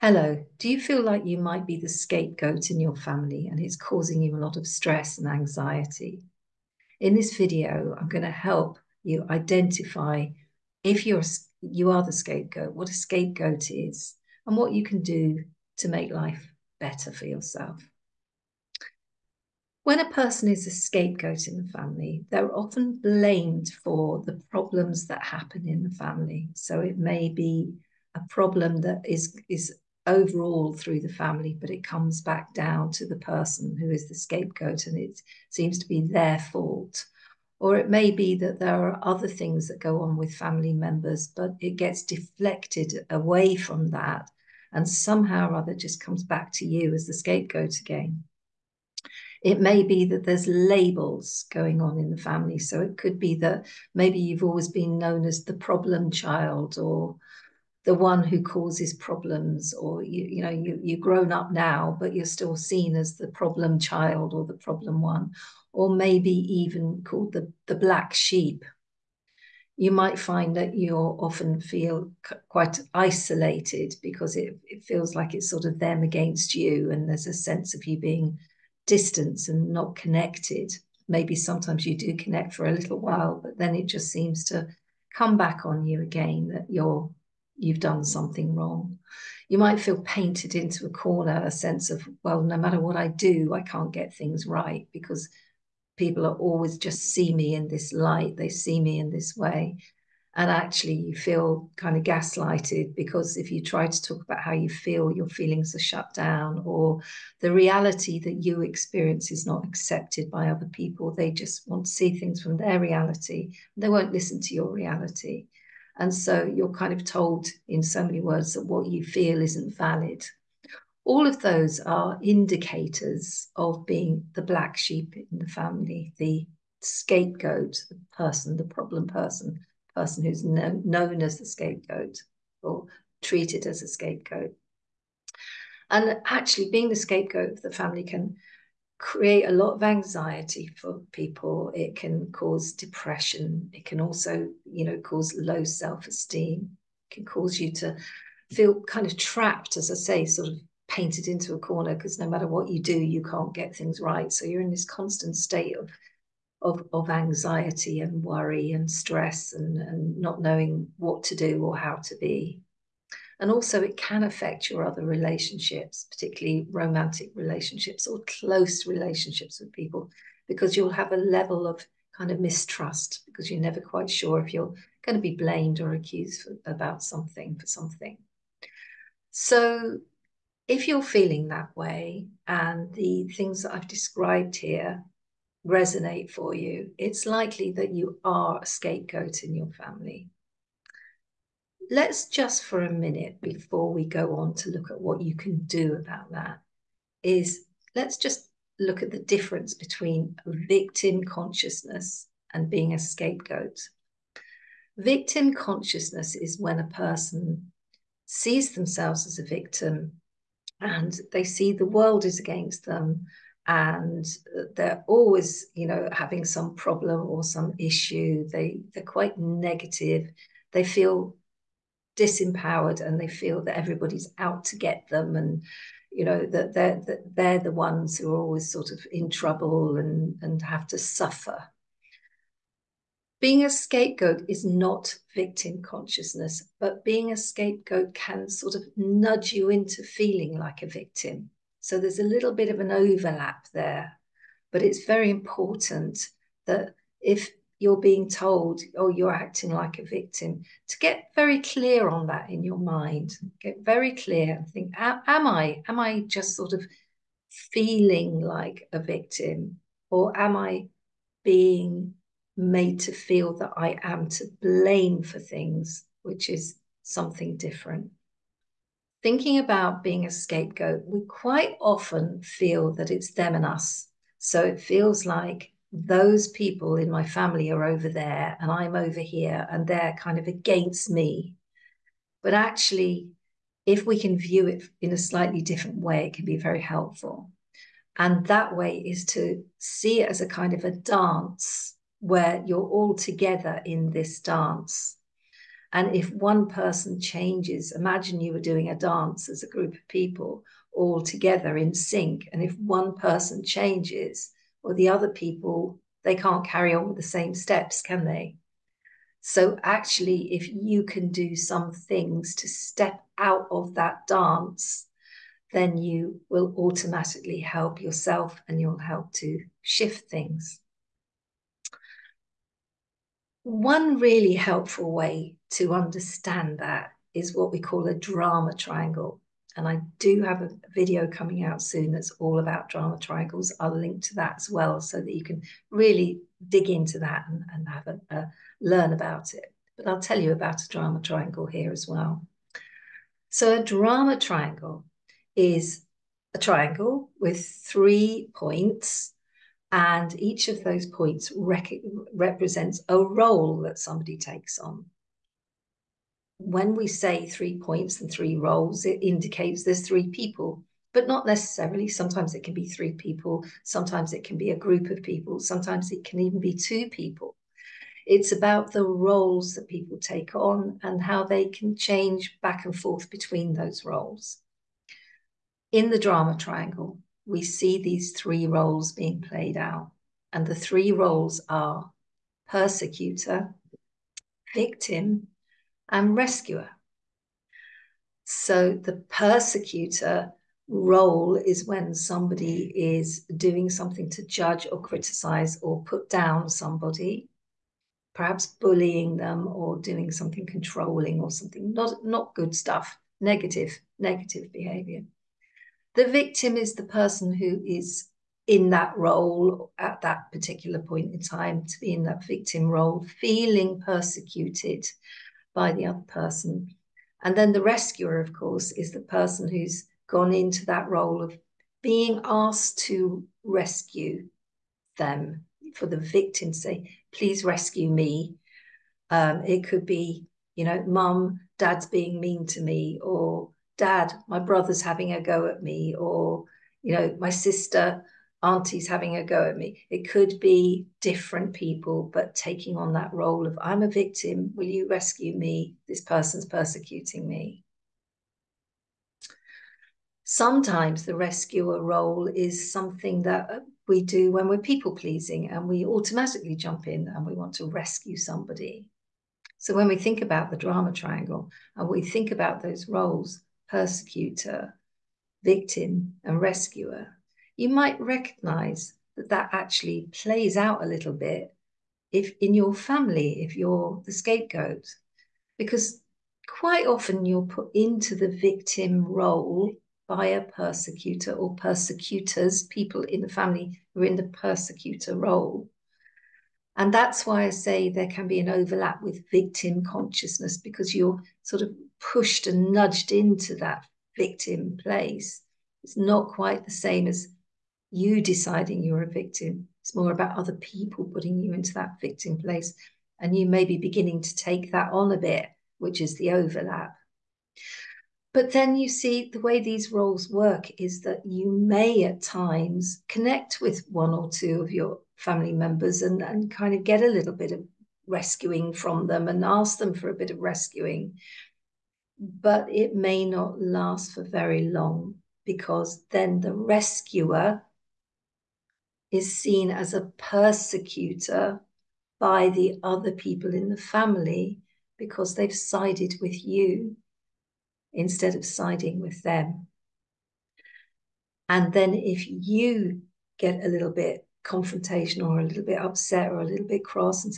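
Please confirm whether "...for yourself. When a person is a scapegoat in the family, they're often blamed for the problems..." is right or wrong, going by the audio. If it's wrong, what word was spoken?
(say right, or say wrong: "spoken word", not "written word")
right.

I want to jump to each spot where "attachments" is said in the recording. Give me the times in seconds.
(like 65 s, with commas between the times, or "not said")
not said.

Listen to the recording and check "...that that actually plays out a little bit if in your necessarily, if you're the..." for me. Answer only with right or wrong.
wrong.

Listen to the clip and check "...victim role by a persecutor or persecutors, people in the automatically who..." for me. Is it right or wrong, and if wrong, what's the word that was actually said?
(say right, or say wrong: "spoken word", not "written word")
wrong: "family", not "automatically".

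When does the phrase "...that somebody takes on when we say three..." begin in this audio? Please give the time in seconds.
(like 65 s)
353 s.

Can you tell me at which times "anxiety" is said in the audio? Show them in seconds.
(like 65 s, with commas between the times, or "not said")
5 s, 139 s, 157 s.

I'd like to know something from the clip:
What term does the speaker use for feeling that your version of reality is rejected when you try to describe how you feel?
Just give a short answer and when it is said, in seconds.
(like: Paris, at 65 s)
gaslighted, at 102 s.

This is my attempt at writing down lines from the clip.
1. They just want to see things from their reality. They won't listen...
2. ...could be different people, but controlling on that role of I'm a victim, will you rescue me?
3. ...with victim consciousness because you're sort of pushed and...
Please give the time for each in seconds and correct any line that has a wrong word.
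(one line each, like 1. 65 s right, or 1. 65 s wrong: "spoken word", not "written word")
1. 111 s right
2. 440 s wrong: "taking", not "controlling"
3. 489 s right.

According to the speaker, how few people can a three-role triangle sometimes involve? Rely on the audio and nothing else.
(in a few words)
2.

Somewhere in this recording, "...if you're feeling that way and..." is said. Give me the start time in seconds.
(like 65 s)
180 s.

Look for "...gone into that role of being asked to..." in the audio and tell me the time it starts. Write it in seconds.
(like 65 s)
420 s.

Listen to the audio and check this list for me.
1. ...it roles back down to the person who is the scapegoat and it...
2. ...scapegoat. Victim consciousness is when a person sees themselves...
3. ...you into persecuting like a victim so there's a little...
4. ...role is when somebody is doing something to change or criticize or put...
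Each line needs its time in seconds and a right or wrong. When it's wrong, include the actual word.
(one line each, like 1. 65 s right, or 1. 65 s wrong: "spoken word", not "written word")
1. 31 s wrong: "comes", not "roles"
2. 202 s right
3. 239 s wrong: "feeling", not "persecuting"
4. 390 s wrong: "judge", not "change".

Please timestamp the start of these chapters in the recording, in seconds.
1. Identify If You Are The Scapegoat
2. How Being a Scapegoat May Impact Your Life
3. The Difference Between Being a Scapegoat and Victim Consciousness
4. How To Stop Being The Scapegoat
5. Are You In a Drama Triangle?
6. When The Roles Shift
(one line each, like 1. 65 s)
1. 19 s
2. 129 s
3. 194 s
4. 267 s
5. 322 s
6. 506 s.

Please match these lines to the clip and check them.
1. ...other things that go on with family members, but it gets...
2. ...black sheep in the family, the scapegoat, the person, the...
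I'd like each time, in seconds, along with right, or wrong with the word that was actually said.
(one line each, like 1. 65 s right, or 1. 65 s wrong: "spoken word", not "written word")
1. 39 s right
2. 124 s right.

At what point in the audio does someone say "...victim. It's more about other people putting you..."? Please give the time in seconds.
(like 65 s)
499 s.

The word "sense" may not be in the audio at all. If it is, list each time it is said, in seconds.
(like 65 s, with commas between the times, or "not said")
77 s, 91 s.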